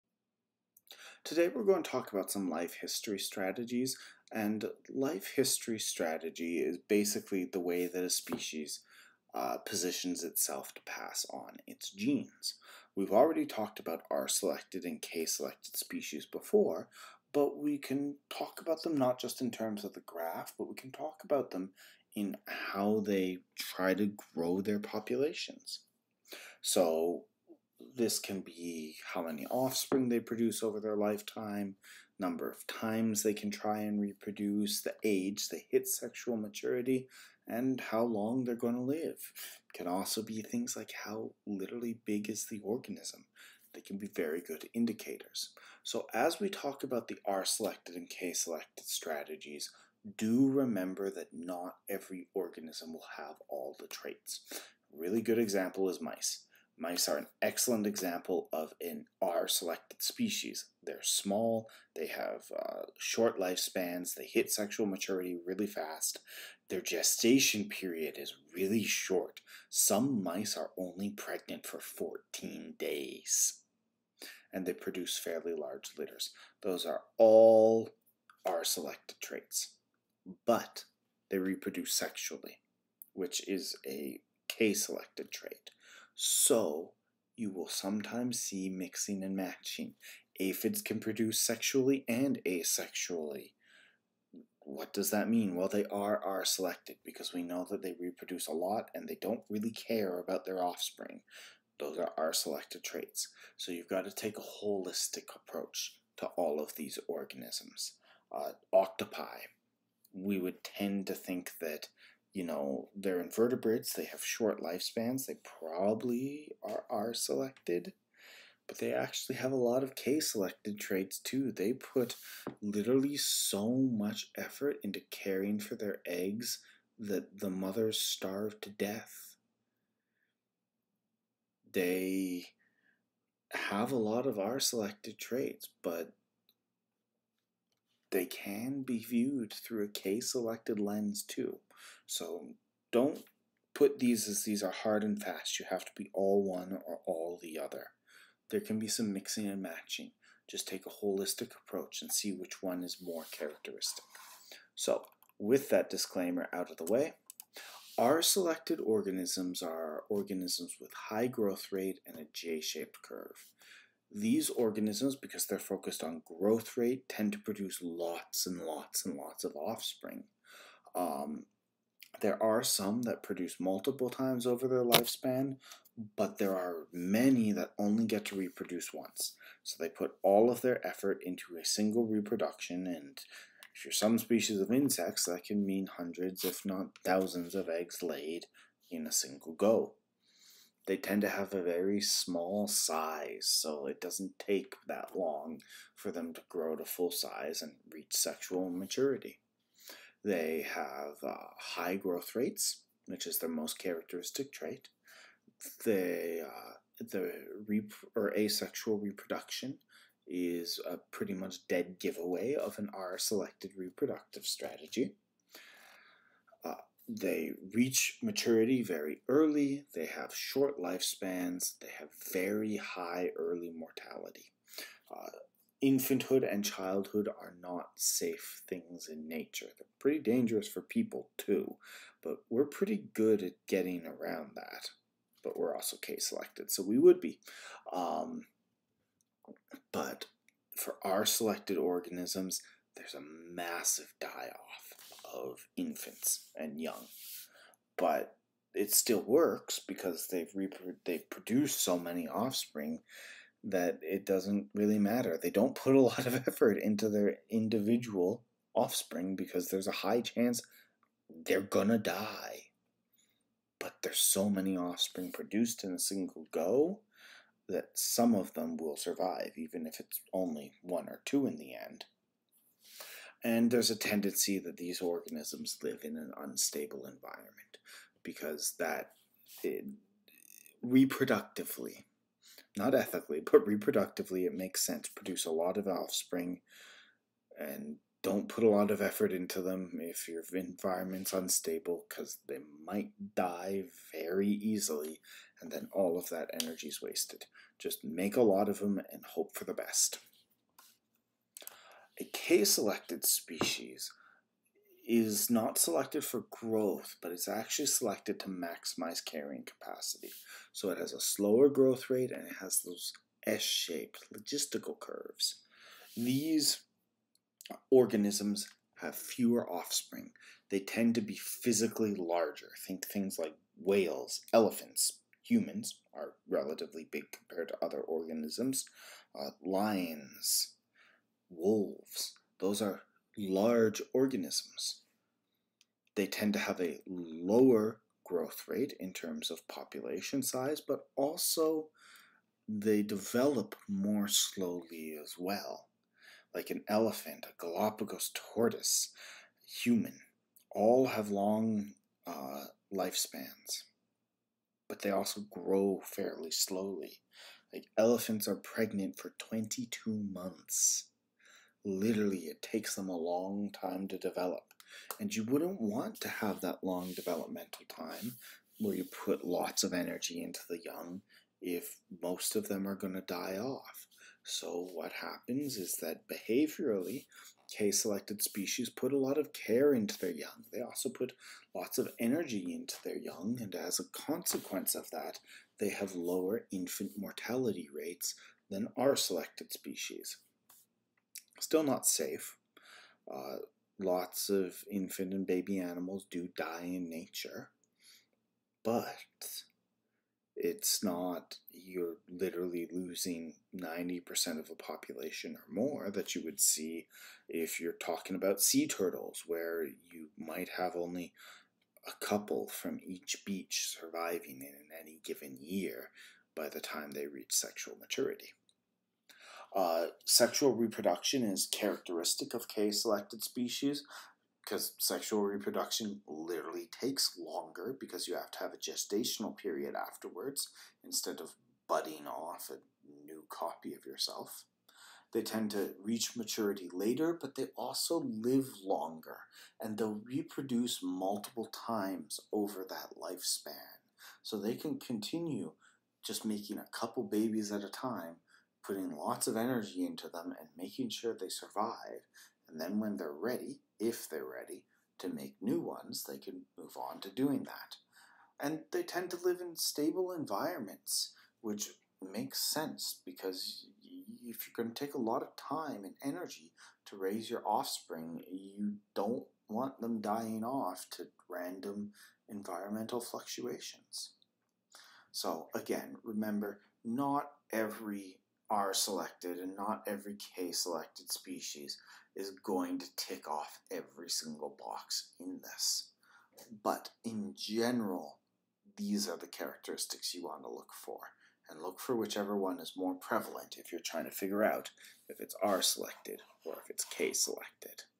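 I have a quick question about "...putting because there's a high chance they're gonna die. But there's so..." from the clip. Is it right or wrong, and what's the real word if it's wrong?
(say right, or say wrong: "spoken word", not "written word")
wrong: "offspring", not "putting".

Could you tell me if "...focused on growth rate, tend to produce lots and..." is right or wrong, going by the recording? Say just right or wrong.
right.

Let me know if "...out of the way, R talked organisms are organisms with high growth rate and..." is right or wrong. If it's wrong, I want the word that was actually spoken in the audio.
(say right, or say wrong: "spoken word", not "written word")
wrong: "selected", not "talked".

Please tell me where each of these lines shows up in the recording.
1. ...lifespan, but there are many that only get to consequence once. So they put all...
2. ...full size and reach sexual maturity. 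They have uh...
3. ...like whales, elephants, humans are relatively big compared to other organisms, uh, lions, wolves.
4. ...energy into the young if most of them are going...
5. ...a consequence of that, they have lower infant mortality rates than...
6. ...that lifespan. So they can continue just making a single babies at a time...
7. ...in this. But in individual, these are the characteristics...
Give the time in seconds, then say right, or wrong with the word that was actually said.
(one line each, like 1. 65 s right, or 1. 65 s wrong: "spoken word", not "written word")
1. 174 s wrong: "reproduce", not "consequence"
2. 196 s right
3. 323 s right
4. 369 s right
5. 383 s right
6. 442 s wrong: "couple", not "single"
7. 485 s wrong: "general", not "individual".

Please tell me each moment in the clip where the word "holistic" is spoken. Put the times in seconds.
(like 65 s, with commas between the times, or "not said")
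104 s, 151 s.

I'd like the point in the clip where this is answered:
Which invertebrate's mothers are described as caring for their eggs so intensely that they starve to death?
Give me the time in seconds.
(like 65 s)
108 s.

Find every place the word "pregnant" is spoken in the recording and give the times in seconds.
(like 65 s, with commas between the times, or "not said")
71 s, 358 s.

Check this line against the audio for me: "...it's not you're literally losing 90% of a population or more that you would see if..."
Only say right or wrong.
right.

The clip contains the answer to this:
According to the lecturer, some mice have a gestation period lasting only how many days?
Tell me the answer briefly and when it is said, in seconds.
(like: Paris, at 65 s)
14 days, at 71 s.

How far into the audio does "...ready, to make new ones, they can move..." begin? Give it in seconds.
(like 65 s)
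454 s.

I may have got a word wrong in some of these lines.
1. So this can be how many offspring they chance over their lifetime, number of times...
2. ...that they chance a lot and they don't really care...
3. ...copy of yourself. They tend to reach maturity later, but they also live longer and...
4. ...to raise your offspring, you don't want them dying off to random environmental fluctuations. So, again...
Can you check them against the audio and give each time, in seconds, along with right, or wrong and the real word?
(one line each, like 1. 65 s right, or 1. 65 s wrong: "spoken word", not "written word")
1. 26 s wrong: "produce", not "chance"
2. 97 s wrong: "reproduce", not "chance"
3. 433 s right
4. 467 s right.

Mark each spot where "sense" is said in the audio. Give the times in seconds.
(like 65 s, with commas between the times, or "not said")
284 s, 462 s.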